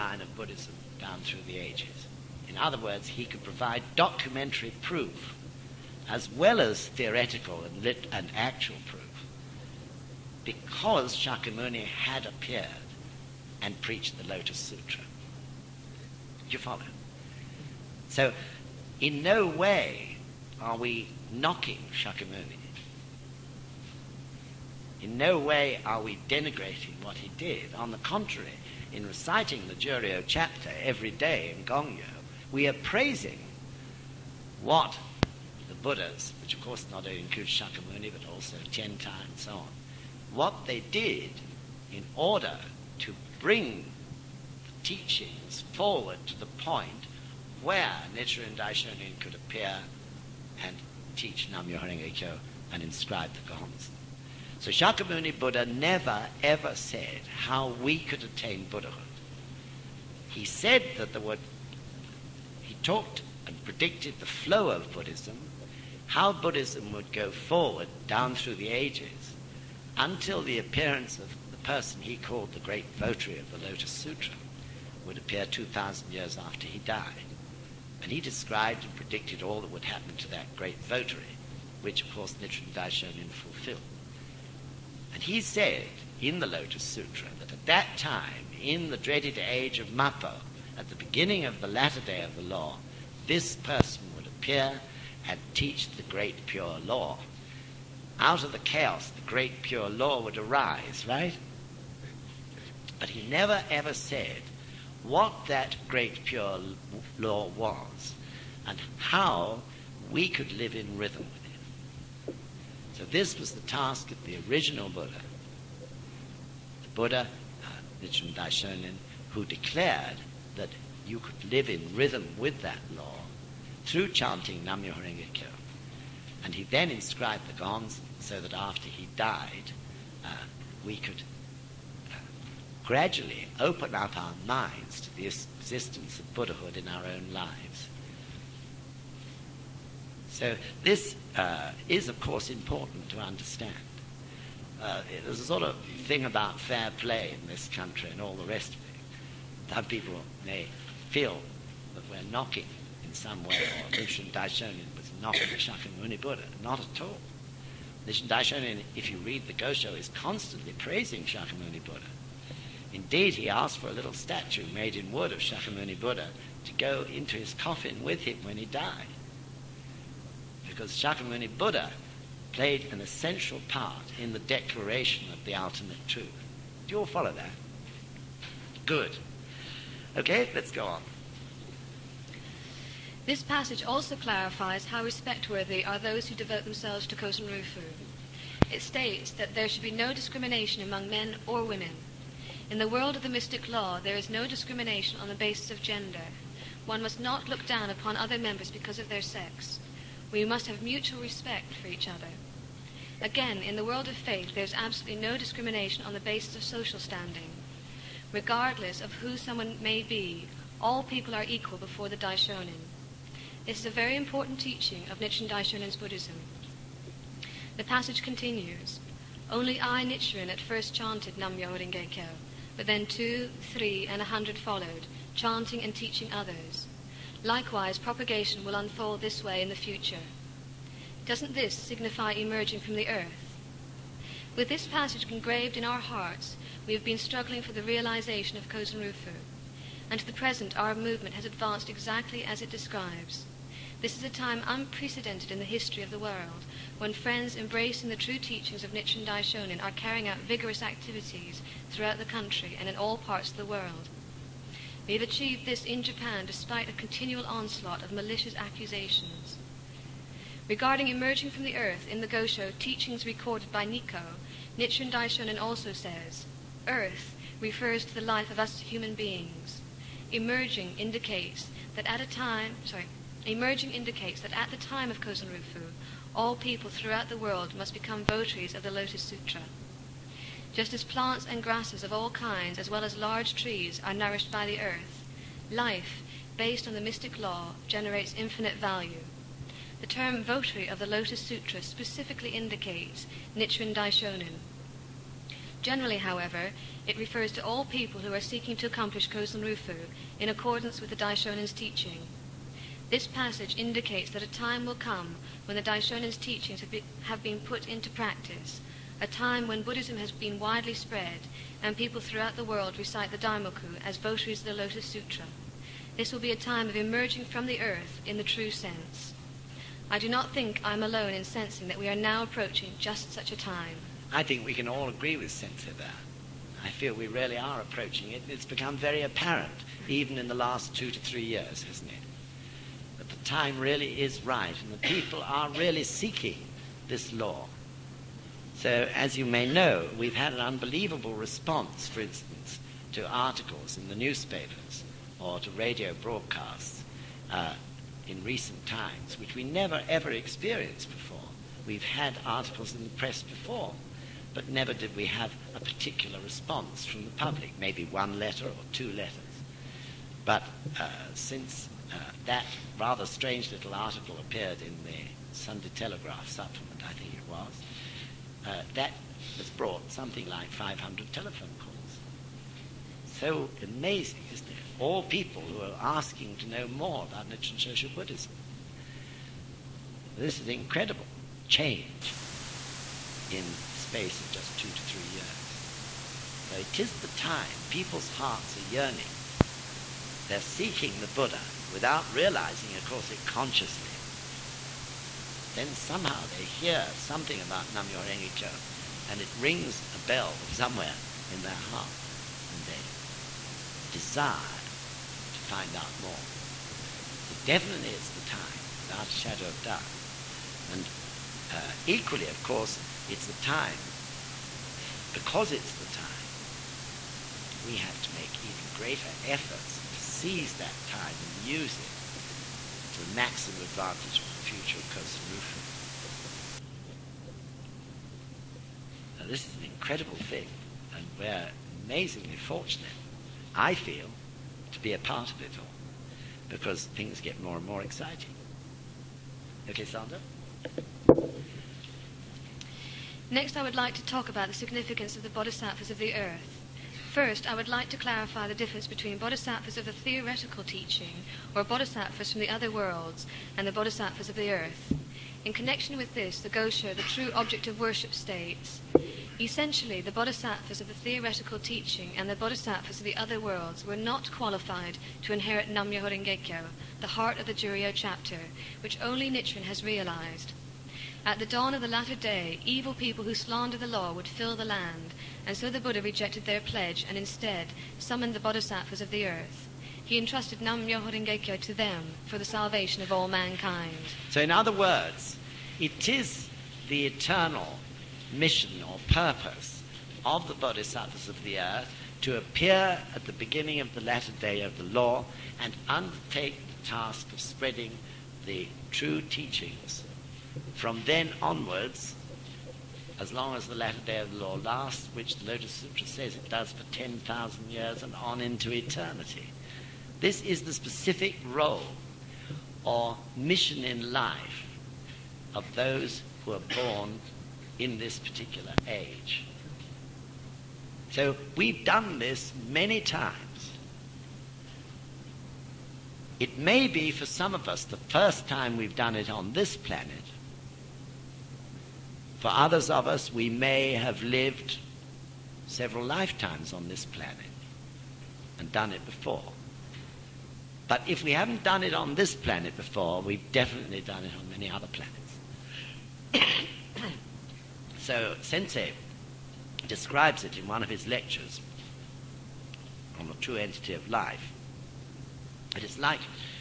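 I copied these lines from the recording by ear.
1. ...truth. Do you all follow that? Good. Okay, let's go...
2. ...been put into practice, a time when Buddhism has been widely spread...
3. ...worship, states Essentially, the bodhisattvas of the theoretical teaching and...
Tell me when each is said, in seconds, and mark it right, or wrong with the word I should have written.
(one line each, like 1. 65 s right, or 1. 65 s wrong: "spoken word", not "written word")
1. 176 s right
2. 307 s right
3. 458 s right.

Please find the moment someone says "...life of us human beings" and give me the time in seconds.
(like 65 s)
268 s.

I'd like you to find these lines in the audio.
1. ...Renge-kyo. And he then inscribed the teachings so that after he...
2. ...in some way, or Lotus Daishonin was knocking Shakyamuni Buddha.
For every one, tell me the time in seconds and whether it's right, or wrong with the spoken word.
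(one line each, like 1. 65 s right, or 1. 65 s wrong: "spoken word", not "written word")
1. 125 s wrong: "gongs", not "teachings"
2. 153 s wrong: "Nichiren", not "Lotus".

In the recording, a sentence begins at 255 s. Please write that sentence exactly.
We have achieved this in Japan despite a continual onslaught of malicious accusations.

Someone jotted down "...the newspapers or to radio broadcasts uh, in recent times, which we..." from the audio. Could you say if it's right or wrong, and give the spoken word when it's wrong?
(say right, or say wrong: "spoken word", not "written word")
right.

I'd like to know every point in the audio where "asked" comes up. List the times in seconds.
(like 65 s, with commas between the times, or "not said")
163 s.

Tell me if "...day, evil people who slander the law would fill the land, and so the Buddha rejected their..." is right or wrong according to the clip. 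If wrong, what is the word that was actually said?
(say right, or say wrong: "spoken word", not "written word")
right.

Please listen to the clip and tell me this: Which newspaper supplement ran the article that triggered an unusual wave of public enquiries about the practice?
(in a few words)
Sunday Telegraph.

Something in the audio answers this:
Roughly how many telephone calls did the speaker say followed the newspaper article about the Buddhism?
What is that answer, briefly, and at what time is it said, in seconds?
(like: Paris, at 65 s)
500, at 370 s.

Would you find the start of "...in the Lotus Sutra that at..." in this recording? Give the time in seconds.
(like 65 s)
86 s.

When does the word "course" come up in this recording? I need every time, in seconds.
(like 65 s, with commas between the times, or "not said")
36 s, 82 s, 142 s, 393 s, 412 s.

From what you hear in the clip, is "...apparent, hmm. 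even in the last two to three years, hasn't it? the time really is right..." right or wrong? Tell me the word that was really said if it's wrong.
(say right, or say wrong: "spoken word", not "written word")
right.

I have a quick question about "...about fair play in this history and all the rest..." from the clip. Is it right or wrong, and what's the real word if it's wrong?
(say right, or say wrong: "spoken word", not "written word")
wrong: "country", not "history".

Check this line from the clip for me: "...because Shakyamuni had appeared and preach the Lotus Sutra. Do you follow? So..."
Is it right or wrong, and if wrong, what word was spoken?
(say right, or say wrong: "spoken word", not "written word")
right.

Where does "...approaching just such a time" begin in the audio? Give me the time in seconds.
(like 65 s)
322 s.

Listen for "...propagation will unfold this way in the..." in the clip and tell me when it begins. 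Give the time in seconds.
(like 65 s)
227 s.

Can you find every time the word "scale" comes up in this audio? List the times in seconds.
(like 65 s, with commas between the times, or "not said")
not said.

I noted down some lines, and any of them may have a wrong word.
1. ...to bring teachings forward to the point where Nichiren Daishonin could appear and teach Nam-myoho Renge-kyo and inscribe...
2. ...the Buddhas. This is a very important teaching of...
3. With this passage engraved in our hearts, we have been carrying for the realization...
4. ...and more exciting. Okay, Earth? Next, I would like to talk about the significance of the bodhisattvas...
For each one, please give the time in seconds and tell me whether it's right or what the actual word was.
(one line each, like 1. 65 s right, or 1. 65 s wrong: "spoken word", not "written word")
1. 42 s right
2. 212 s wrong: "Daishonin", not "Buddhas"
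3. 234 s wrong: "struggling", not "carrying"
4. 437 s wrong: "Sandra", not "Earth".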